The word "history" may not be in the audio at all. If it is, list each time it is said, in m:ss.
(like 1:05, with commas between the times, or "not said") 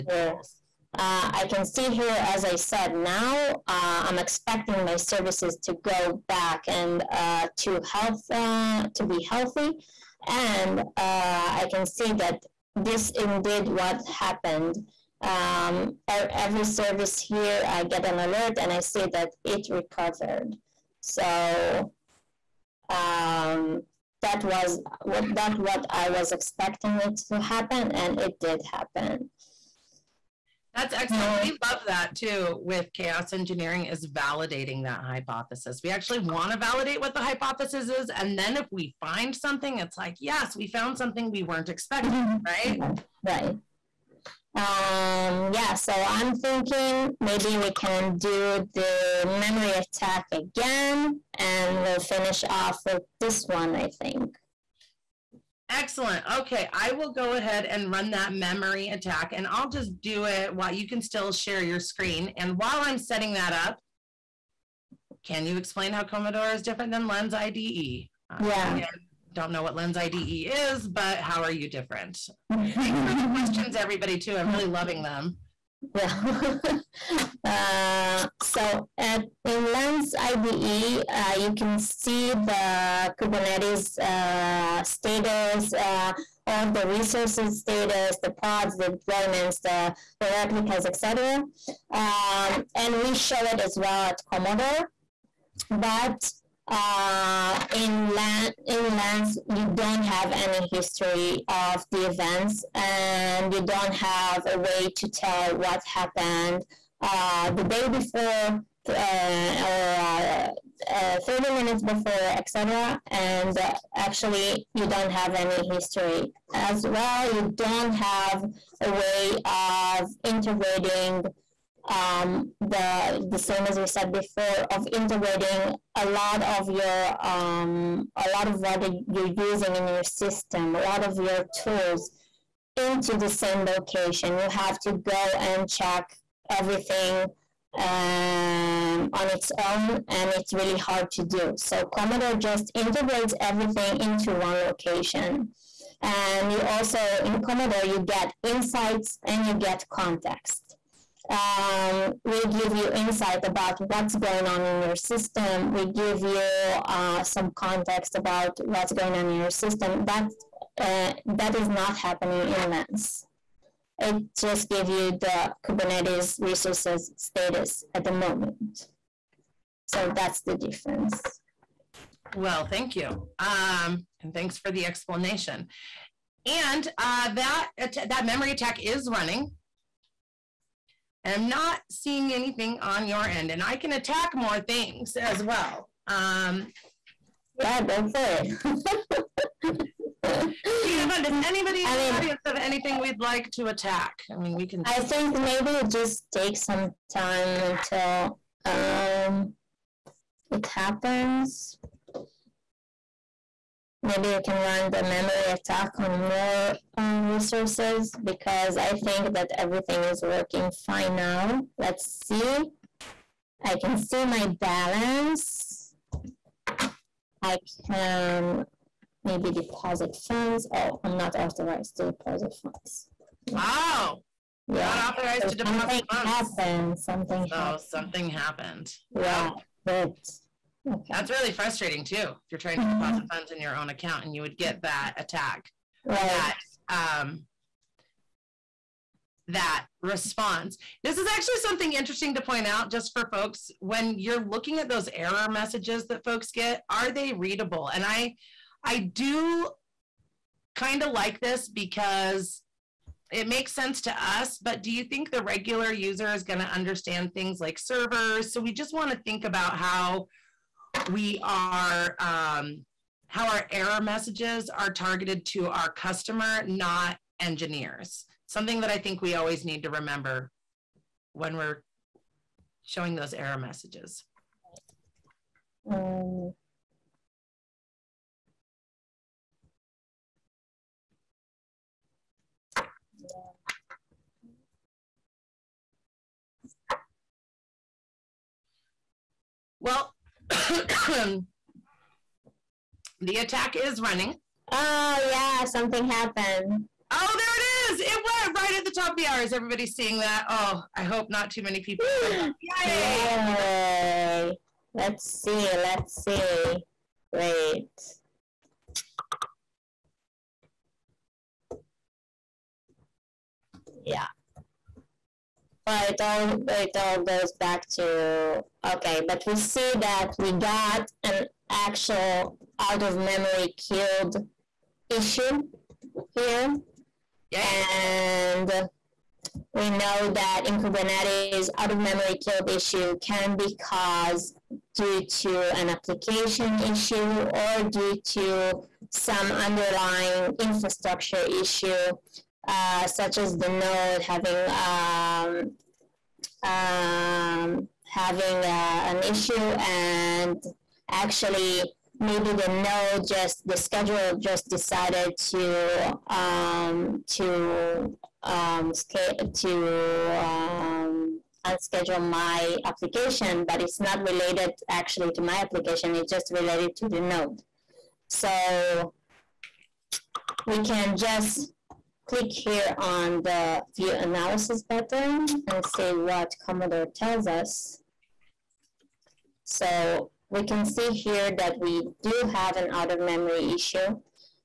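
1:40, 1:55.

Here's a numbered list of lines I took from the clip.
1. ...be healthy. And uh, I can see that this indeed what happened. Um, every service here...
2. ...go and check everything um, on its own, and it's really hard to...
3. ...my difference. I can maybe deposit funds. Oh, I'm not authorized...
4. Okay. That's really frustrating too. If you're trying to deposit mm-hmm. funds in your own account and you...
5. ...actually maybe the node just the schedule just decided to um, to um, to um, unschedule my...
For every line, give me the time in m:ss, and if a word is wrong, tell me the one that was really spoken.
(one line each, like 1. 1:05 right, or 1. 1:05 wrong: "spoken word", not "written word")
1. 0:09 right
2. 2:14 right
3. 3:34 wrong: "balance", not "difference"
4. 3:50 right
5. 5:51 right.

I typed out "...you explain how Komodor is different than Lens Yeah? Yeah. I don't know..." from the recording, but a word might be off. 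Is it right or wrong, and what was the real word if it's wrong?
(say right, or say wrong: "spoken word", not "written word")
wrong: "IDE", not "Yeah".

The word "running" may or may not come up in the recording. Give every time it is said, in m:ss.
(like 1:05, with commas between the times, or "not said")
2:59, 4:54.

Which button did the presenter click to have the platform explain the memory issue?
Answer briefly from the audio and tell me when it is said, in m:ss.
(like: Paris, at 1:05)
View analysis, at 6:13.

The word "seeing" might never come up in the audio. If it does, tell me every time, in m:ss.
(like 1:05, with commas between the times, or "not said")
3:01, 4:59.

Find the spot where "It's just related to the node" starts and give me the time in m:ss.
6:06.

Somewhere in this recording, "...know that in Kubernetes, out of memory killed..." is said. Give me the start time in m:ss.
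5:29.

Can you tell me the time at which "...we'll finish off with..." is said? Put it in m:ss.
0:51.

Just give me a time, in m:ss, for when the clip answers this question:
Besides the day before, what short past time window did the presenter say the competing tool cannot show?
1:51.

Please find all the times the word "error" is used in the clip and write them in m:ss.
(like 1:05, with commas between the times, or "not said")
4:05, 4:23, 4:33.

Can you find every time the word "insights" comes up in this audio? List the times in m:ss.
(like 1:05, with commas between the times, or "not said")
2:28, 2:32.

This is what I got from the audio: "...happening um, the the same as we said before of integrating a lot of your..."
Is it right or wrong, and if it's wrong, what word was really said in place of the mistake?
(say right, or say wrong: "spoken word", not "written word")
wrong: "integrating", not "happening".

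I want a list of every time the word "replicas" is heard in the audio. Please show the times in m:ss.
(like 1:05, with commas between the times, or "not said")
1:30.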